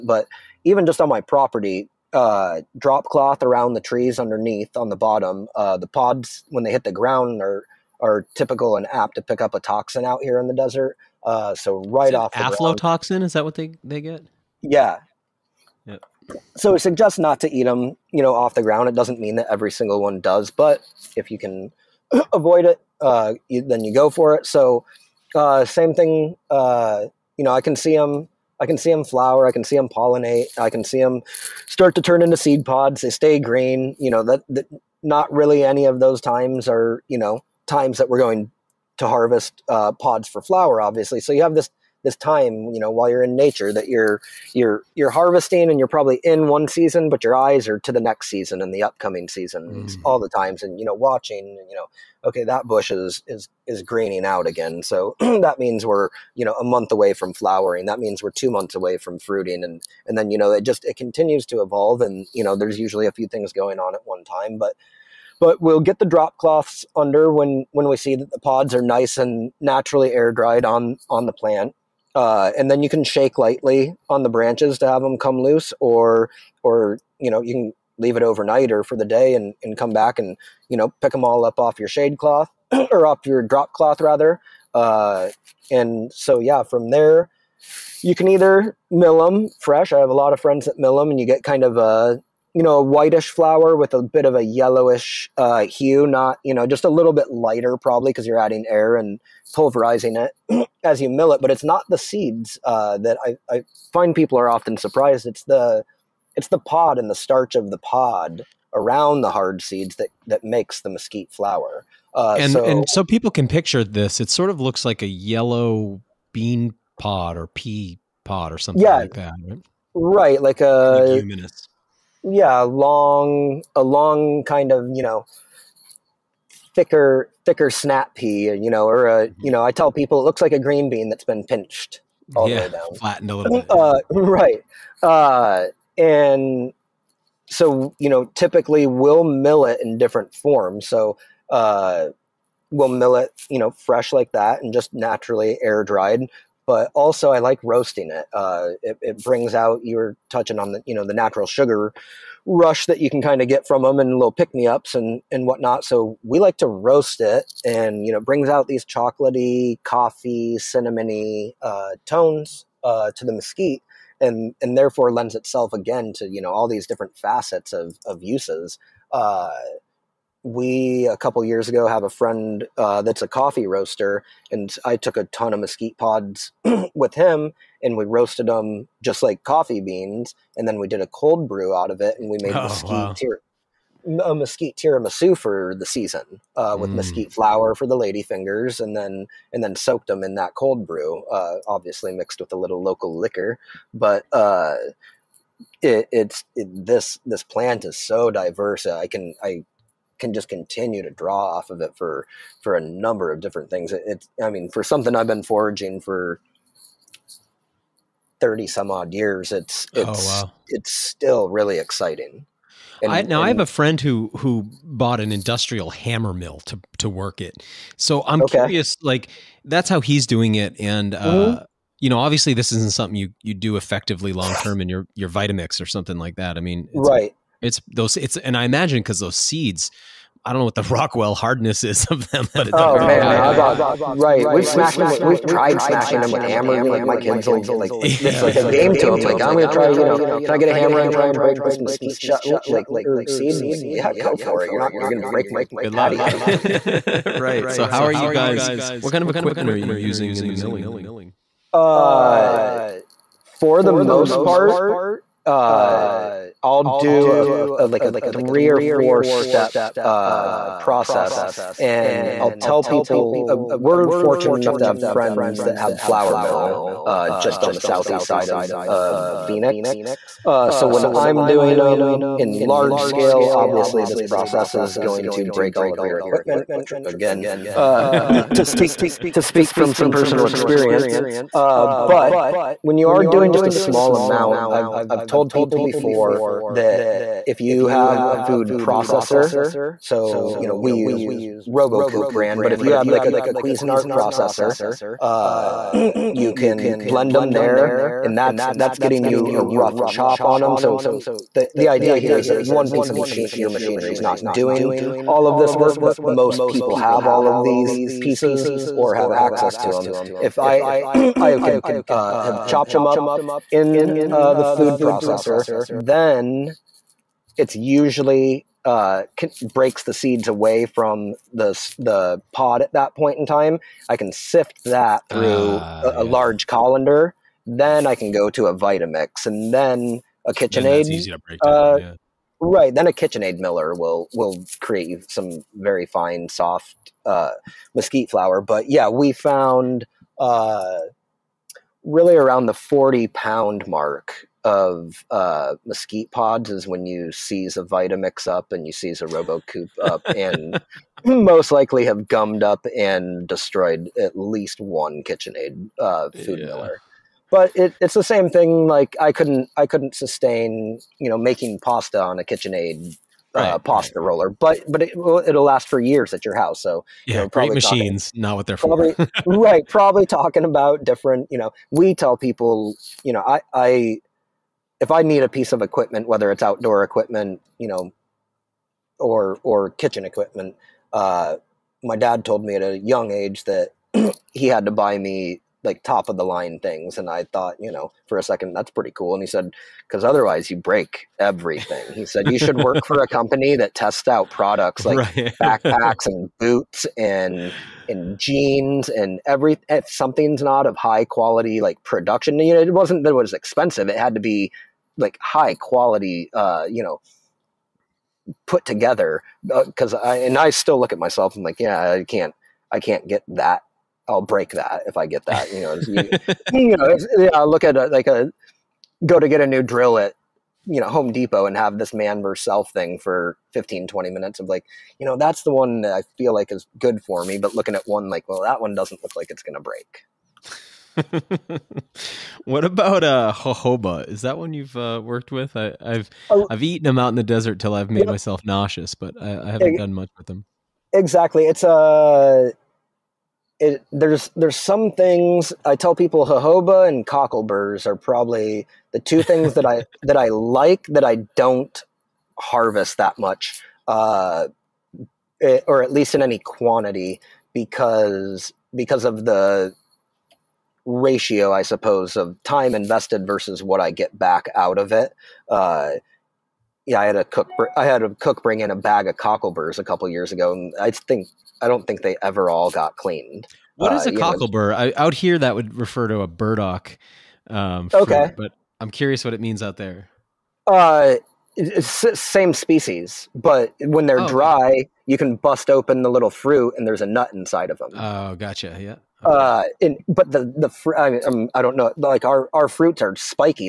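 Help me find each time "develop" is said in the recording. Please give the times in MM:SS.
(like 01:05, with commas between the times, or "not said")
not said.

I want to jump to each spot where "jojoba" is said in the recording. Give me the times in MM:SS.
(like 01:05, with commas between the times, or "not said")
07:13, 07:26.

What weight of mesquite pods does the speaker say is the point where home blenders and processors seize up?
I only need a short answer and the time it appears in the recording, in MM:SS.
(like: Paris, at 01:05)
40 pounds, at 05:42.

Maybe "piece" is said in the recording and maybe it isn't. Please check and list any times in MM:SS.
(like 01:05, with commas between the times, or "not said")
05:02, 05:08, 06:15.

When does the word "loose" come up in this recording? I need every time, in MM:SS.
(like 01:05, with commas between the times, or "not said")
01:15.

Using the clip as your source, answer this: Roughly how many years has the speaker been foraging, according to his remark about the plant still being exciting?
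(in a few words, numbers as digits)
30.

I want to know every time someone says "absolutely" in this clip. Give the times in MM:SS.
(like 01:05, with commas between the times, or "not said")
not said.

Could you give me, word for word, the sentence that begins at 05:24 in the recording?
I can sift that through uh, a, a large colander.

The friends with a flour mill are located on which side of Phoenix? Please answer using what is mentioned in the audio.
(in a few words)
southeast.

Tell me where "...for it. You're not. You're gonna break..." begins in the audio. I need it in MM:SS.
04:04.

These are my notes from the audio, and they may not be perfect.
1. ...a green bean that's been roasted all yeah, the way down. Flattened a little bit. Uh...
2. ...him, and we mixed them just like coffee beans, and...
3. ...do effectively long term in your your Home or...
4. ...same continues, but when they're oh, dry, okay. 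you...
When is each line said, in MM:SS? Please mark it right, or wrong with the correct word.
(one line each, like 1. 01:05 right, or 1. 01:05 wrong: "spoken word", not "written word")
1. 02:10 wrong: "pinched", not "roasted"
2. 02:57 wrong: "roasted", not "mixed"
3. 03:43 wrong: "Vitamix", not "Home"
4. 08:02 wrong: "species", not "continues".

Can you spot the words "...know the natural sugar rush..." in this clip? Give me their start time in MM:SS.
02:30.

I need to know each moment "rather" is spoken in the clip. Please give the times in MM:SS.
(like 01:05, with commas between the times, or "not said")
01:24.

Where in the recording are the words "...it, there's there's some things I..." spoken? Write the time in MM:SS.
07:23.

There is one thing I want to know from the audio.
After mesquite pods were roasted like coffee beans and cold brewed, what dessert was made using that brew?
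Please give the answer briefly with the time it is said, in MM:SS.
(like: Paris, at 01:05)
mesquite tiramisu, at 03:04.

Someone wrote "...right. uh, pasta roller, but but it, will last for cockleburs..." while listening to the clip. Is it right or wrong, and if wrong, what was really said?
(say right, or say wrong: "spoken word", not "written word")
wrong: "years", not "cockleburs".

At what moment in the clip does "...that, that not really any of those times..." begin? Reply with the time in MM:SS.
00:34.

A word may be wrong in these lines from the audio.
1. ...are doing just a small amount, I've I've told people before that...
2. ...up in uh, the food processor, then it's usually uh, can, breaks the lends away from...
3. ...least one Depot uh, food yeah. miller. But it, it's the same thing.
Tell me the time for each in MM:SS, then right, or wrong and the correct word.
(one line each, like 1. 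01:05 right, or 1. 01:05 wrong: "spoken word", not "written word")
1. 04:43 right
2. 05:13 wrong: "seeds", not "lends"
3. 05:54 wrong: "KitchenAid", not "Depot".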